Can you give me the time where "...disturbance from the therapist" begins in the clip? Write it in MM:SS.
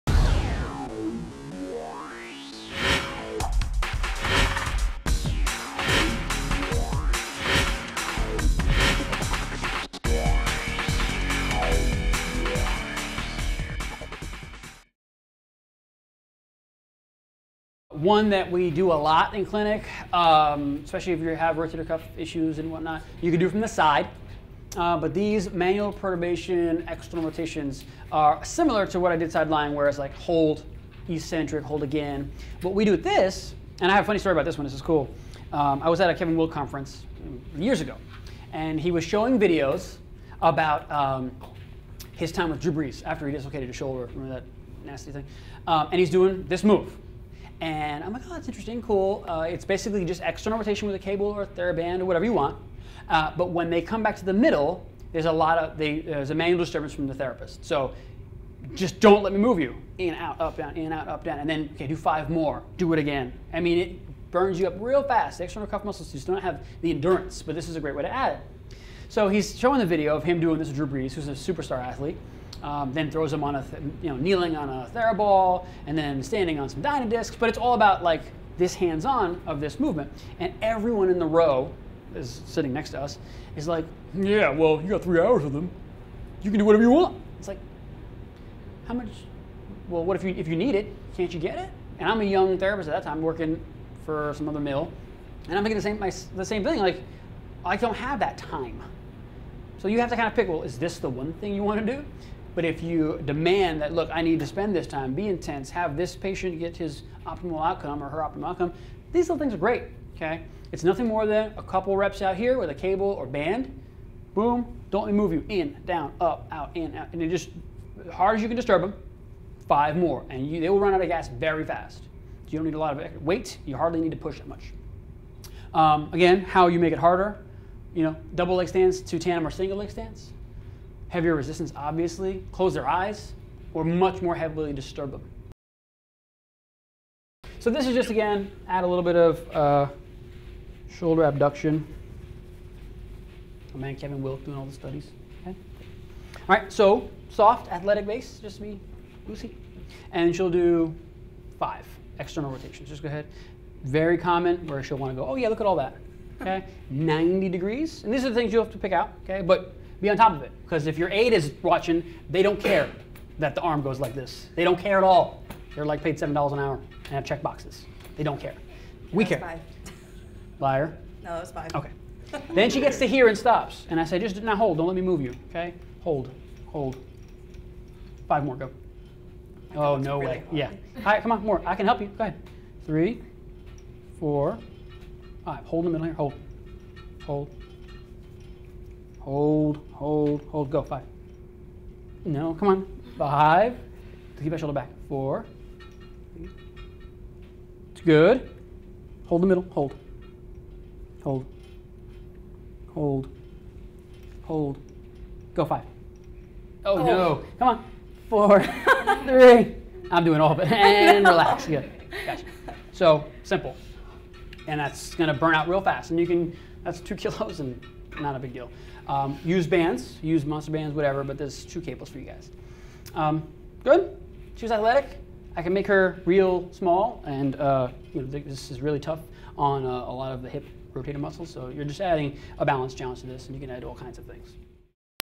00:56.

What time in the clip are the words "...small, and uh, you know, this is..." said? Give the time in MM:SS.
03:46.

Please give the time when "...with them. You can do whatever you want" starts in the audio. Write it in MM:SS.
01:25.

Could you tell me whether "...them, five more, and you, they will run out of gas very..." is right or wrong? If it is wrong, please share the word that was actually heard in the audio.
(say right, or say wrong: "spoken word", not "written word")
right.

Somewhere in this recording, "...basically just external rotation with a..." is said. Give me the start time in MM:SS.
00:49.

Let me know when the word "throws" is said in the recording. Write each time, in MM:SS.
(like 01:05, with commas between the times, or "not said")
01:13.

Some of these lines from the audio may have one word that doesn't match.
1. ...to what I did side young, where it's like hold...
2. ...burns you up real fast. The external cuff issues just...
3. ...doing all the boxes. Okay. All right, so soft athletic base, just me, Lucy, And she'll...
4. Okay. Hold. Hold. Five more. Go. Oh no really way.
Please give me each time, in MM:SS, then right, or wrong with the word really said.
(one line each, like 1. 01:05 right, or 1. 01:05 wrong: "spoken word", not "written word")
1. 00:28 wrong: "lying", not "young"
2. 01:04 wrong: "muscles", not "issues"
3. 02:24 wrong: "studies", not "boxes"
4. 02:55 right.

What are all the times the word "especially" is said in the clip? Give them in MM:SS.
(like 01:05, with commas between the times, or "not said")
00:20.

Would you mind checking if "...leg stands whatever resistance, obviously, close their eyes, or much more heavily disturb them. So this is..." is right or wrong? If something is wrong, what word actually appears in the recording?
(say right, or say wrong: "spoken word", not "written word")
wrong: "heavier", not "whatever".